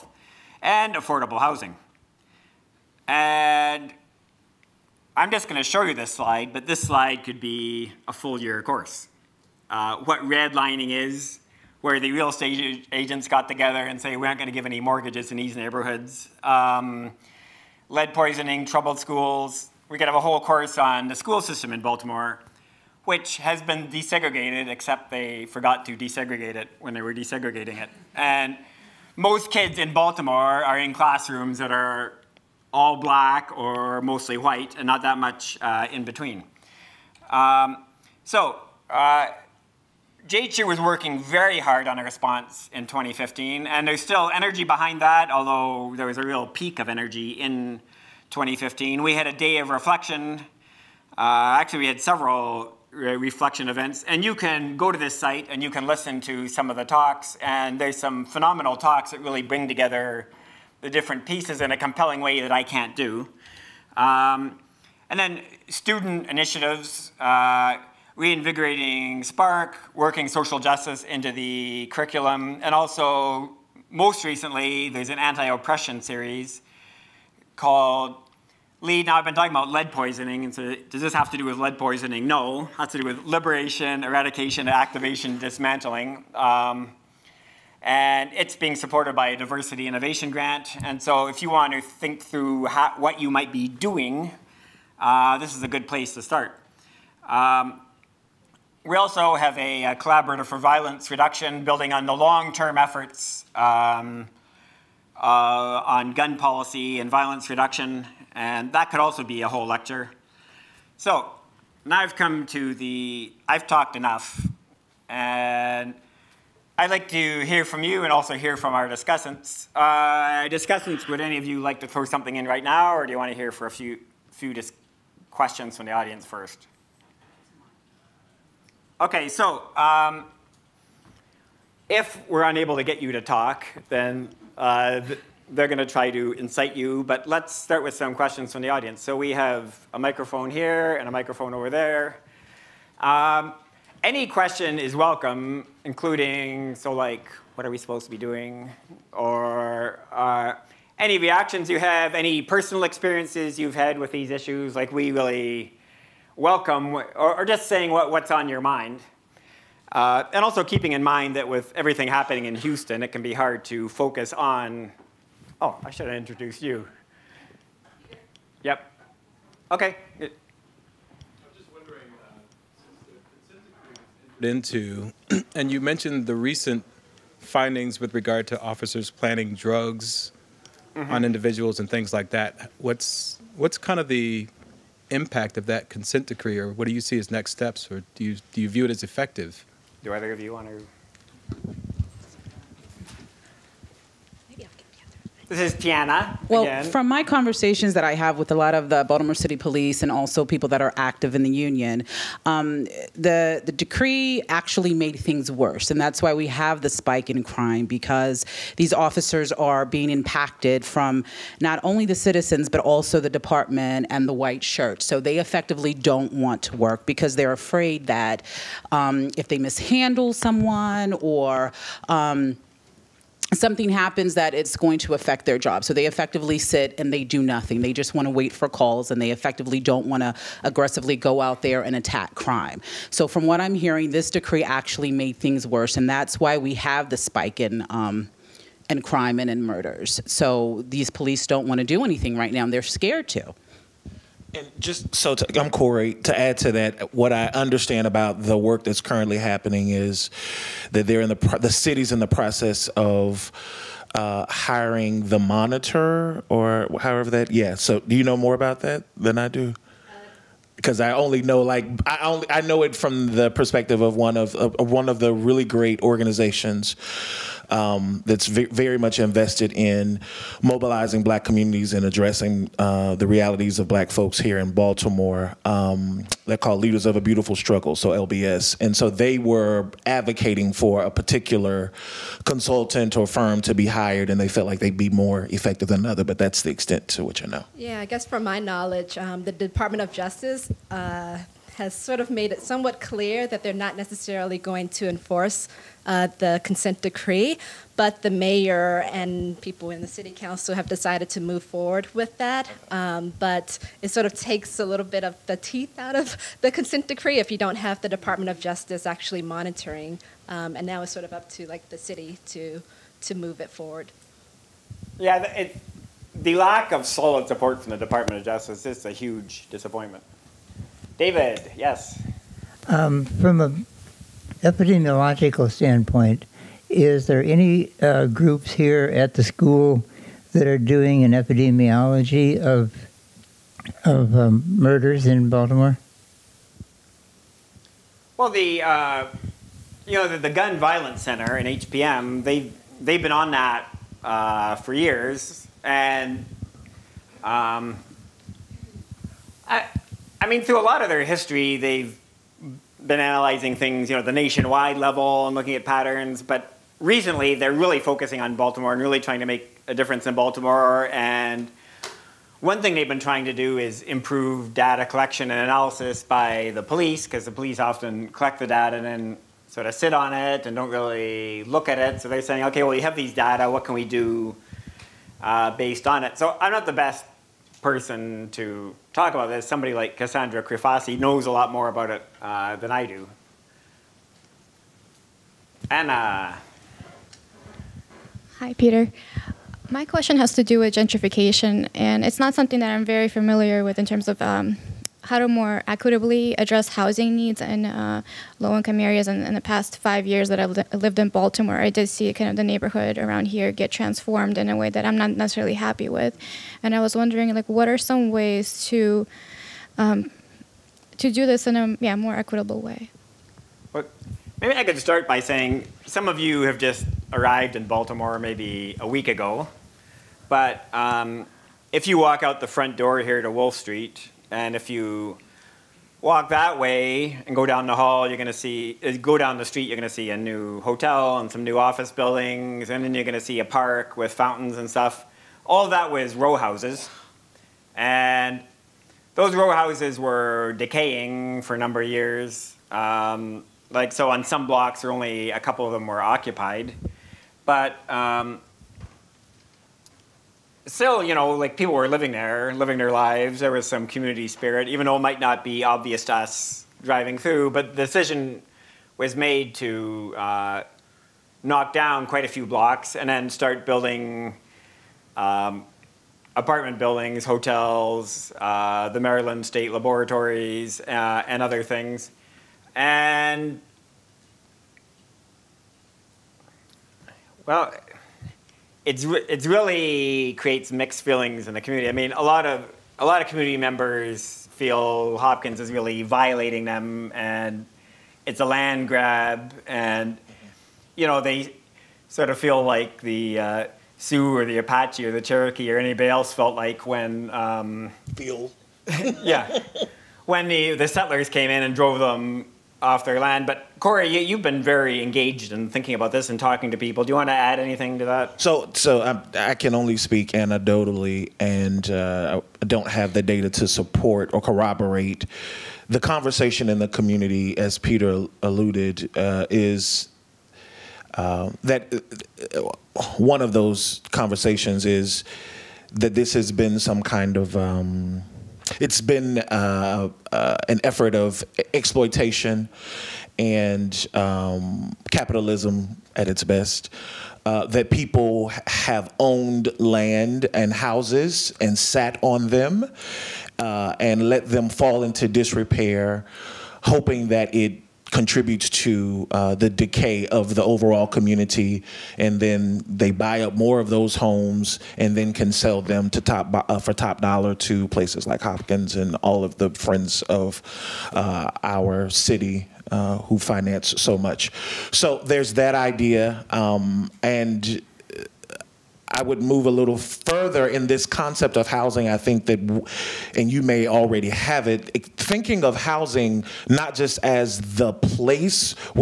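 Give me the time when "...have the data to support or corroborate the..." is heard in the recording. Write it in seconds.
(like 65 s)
513 s.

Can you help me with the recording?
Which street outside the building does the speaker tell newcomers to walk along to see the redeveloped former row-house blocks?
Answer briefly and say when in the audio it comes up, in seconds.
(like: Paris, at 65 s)
Wolfe Street, at 423 s.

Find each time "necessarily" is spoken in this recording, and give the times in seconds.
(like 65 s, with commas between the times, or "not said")
293 s, 405 s.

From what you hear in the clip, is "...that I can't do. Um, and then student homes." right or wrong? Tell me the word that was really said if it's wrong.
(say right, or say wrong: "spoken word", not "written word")
wrong: "initiatives", not "homes".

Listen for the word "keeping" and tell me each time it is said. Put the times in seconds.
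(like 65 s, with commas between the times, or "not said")
160 s.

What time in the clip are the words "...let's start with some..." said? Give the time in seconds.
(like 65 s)
137 s.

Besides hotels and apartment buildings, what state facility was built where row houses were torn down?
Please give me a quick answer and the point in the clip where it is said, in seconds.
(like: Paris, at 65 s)
Maryland State Laboratories, at 469 s.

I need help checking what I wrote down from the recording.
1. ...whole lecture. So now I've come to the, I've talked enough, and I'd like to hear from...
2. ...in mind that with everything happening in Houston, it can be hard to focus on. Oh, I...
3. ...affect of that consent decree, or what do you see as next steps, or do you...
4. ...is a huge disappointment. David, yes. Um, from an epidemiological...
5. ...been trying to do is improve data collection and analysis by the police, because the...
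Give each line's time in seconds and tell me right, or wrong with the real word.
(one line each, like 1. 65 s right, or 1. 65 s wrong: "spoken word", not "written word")
1. 109 s right
2. 160 s right
3. 185 s wrong: "impact", not "affect"
4. 318 s right
5. 363 s right.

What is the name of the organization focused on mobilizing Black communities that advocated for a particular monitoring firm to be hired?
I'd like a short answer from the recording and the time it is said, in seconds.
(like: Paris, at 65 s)
Leaders of a Beautiful Struggle, at 276 s.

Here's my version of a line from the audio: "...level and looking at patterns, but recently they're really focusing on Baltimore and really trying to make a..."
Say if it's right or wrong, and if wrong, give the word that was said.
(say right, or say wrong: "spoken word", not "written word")
right.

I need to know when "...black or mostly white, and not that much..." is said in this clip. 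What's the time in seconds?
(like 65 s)
32 s.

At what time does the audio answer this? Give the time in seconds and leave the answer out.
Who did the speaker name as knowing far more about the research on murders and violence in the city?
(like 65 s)
380 s.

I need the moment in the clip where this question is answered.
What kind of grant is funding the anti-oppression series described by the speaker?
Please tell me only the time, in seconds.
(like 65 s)
89 s.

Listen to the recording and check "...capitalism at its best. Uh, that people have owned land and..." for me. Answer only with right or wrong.
right.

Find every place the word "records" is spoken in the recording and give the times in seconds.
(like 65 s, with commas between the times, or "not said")
not said.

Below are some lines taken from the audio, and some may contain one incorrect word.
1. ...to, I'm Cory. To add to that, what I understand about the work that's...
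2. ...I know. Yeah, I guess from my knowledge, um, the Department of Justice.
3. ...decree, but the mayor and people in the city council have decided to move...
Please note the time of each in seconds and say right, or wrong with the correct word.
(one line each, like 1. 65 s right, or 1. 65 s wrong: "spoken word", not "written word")
1. 245 s right
2. 287 s right
3. 297 s right.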